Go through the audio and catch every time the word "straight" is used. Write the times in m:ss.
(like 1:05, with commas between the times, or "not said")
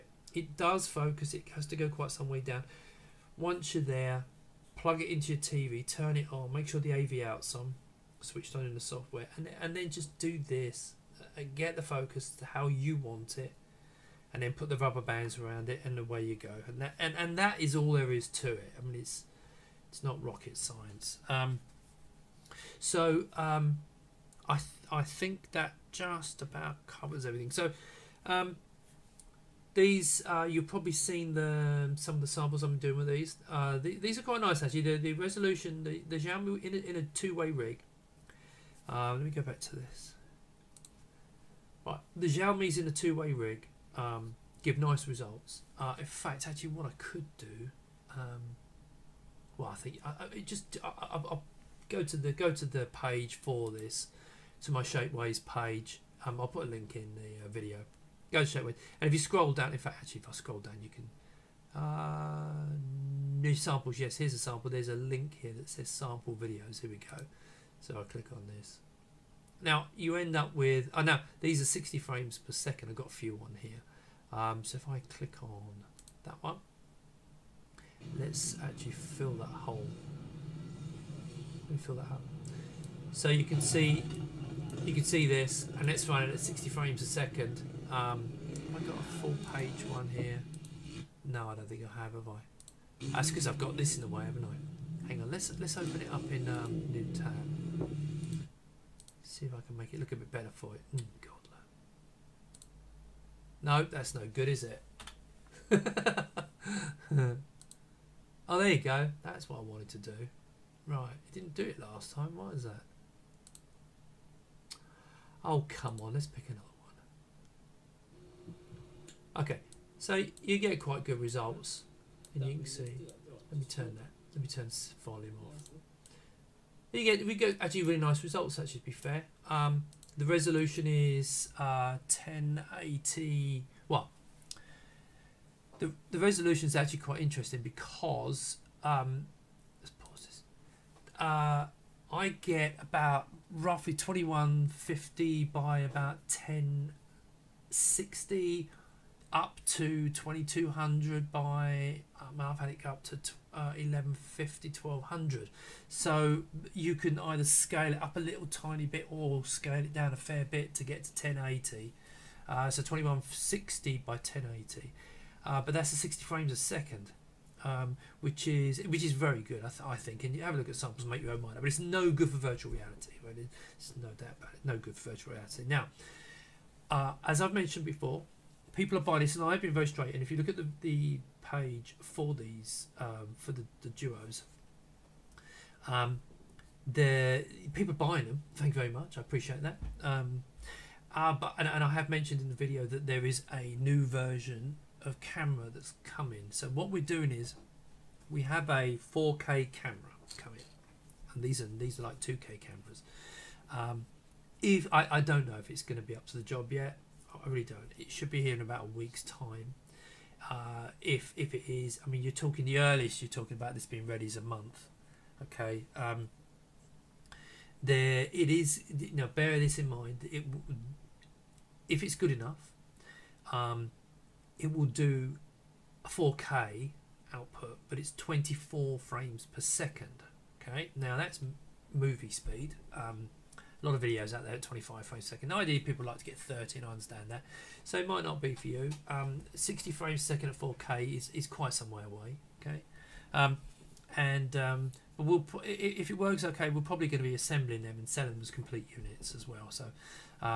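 0:58, 2:59.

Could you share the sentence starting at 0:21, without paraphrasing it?
Um, so um, I th- I think that just about covers everything.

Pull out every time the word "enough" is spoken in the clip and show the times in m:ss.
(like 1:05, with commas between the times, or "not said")
3:42.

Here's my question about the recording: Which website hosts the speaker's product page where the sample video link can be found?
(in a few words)
Shapeways.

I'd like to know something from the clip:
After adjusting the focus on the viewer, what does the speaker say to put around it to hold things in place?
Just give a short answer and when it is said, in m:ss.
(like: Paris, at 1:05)
rubber bands, at 0:14.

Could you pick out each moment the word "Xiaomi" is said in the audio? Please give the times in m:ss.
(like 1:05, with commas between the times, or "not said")
0:36, 0:42.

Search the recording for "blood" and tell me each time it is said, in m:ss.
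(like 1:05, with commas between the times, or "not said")
not said.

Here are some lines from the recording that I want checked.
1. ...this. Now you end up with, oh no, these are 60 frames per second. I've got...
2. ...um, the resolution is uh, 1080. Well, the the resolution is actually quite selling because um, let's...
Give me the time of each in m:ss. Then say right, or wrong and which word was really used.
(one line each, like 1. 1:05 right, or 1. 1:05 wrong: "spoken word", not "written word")
1. 1:08 right
2. 2:09 wrong: "interesting", not "selling".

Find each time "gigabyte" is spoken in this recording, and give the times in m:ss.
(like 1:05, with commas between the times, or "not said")
not said.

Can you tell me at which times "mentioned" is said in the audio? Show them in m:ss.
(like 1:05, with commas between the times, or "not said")
2:57, 3:12.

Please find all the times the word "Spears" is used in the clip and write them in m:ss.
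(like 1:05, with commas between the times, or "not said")
not said.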